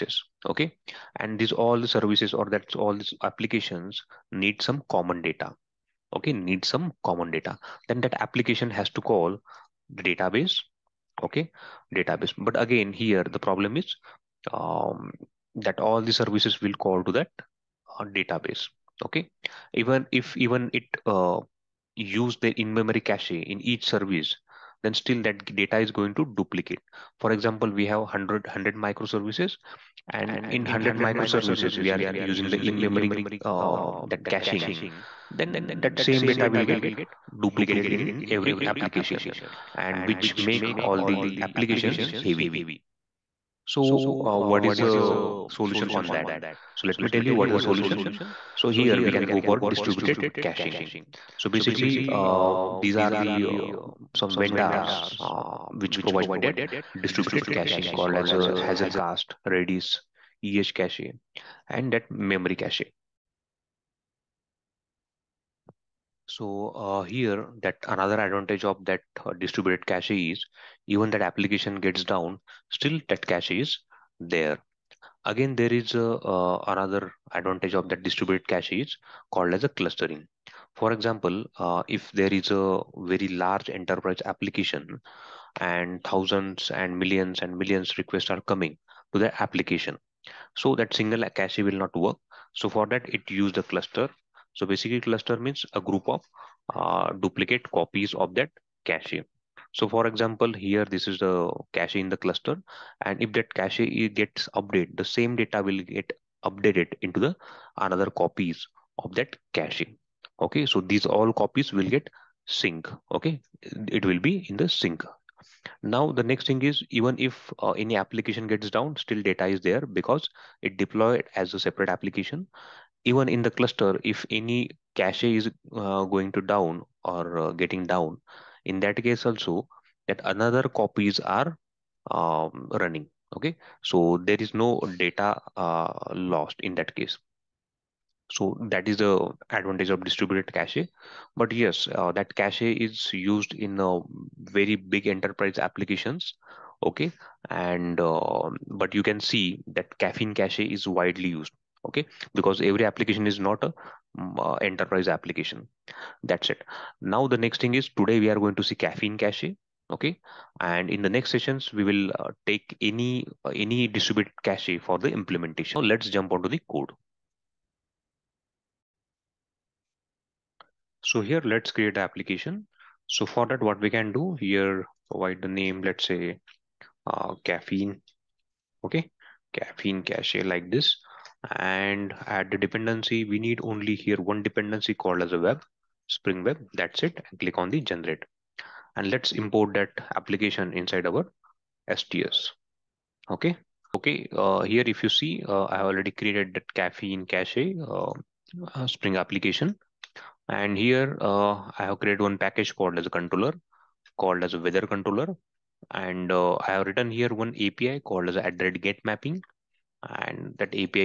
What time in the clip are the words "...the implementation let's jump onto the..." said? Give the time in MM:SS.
02:44.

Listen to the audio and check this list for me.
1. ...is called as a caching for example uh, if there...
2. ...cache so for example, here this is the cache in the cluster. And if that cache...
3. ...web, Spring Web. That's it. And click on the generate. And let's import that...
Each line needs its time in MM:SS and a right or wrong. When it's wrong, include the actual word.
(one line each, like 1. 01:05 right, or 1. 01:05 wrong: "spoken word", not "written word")
1. 01:18 wrong: "clustering", not "caching"
2. 01:38 right
3. 03:05 right.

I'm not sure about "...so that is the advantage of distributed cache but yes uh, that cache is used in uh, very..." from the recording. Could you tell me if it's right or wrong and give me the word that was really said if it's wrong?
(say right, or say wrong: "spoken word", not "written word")
right.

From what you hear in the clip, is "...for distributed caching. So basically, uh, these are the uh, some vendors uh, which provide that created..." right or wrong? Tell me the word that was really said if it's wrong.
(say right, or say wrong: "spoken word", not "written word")
wrong: "distributed", not "created".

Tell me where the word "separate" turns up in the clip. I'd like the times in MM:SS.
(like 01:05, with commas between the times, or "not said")
02:01.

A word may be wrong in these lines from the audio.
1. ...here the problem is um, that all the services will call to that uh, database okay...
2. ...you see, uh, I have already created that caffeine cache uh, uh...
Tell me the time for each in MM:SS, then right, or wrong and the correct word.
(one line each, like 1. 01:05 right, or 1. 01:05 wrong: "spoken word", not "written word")
1. 00:12 right
2. 03:15 right.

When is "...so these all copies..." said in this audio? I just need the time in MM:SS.
01:50.